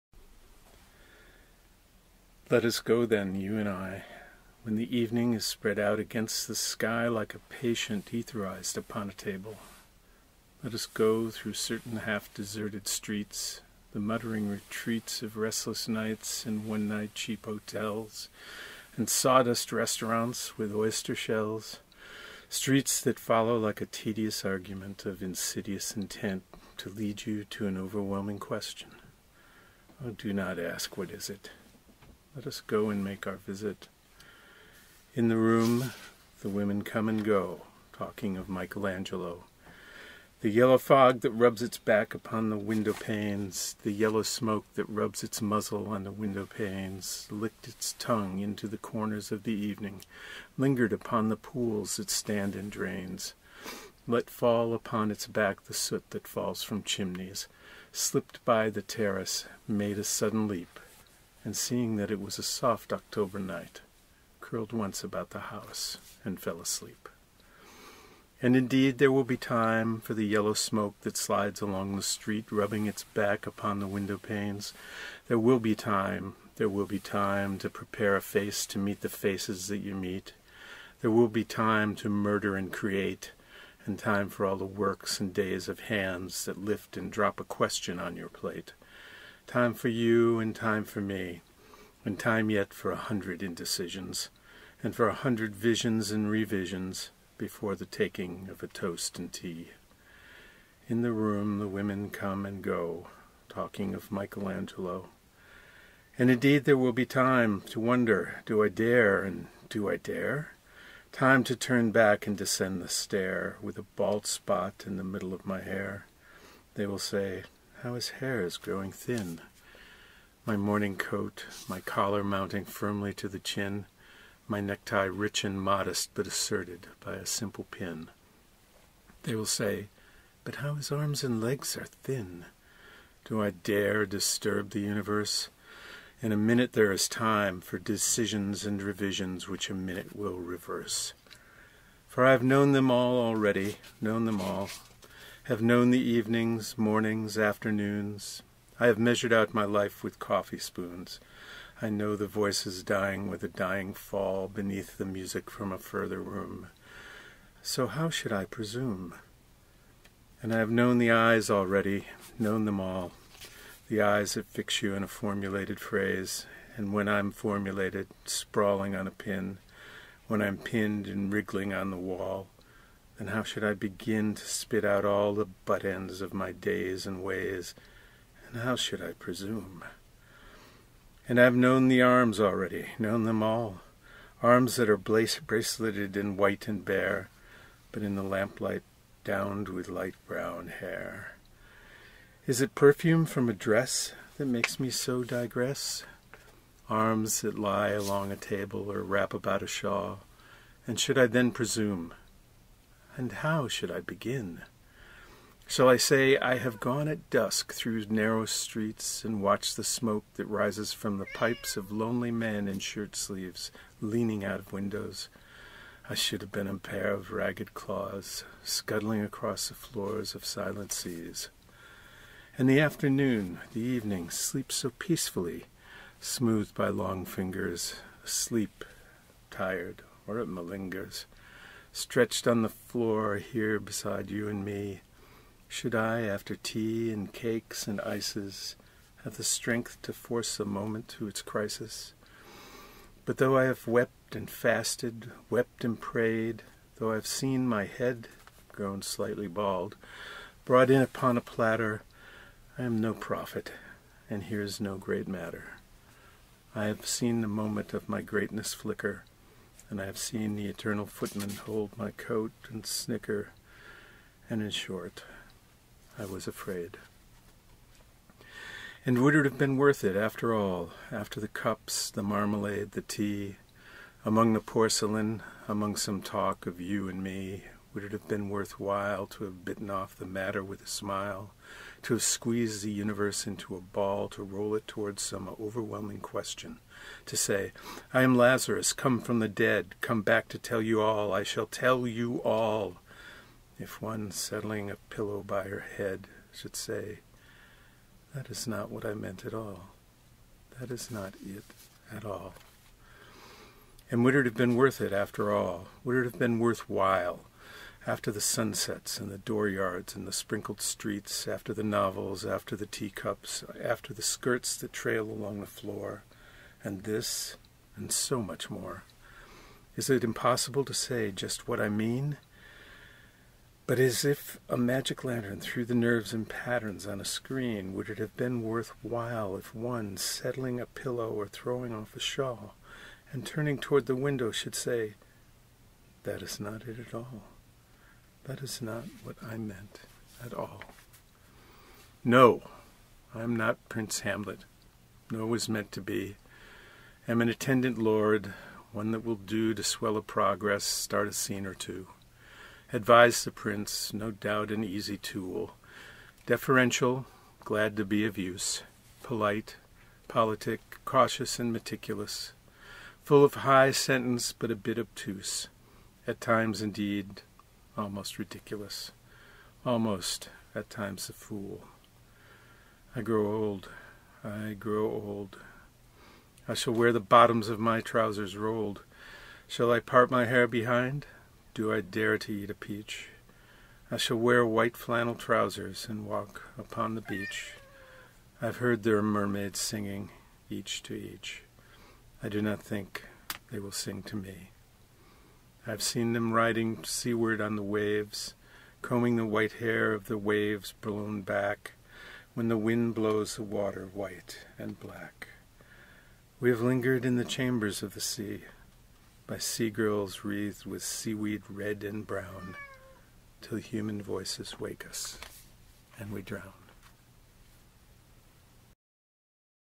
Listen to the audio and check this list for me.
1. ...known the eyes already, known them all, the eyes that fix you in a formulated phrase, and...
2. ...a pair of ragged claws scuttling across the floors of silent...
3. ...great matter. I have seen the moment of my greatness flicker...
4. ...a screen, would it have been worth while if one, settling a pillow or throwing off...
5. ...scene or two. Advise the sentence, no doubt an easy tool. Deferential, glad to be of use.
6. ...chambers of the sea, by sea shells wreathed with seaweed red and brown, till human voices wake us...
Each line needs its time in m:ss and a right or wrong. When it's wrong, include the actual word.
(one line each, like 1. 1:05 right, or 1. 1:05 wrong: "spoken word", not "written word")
1. 2:40 right
2. 3:36 right
3. 4:14 right
4. 5:27 right
5. 5:51 wrong: "prince", not "sentence"
6. 6:47 wrong: "girls", not "shells".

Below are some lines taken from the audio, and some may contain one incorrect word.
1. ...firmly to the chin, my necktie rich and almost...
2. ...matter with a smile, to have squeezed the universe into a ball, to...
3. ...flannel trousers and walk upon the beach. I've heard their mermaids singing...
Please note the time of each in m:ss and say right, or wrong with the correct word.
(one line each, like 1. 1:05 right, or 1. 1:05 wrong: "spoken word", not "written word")
1. 2:02 wrong: "modest", not "almost"
2. 4:40 right
3. 6:24 right.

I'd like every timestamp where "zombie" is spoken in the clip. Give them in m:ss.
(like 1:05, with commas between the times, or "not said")
not said.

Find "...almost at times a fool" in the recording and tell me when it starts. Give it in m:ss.
6:09.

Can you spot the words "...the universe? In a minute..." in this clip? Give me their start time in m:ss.
2:14.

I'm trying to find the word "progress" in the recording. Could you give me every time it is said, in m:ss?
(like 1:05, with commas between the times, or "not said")
5:50.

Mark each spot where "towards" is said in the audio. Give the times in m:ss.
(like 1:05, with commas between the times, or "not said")
4:44, 5:33.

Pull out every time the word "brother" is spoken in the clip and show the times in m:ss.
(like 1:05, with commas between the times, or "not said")
not said.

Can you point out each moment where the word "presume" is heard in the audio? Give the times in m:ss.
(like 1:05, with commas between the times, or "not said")
2:38, 2:59, 3:21.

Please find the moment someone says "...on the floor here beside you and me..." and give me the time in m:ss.
3:52.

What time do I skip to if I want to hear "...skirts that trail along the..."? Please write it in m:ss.
5:14.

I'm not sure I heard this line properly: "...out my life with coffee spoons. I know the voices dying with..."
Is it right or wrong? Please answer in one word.
right.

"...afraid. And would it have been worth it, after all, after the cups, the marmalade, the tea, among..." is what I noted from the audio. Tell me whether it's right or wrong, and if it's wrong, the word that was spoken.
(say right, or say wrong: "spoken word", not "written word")
right.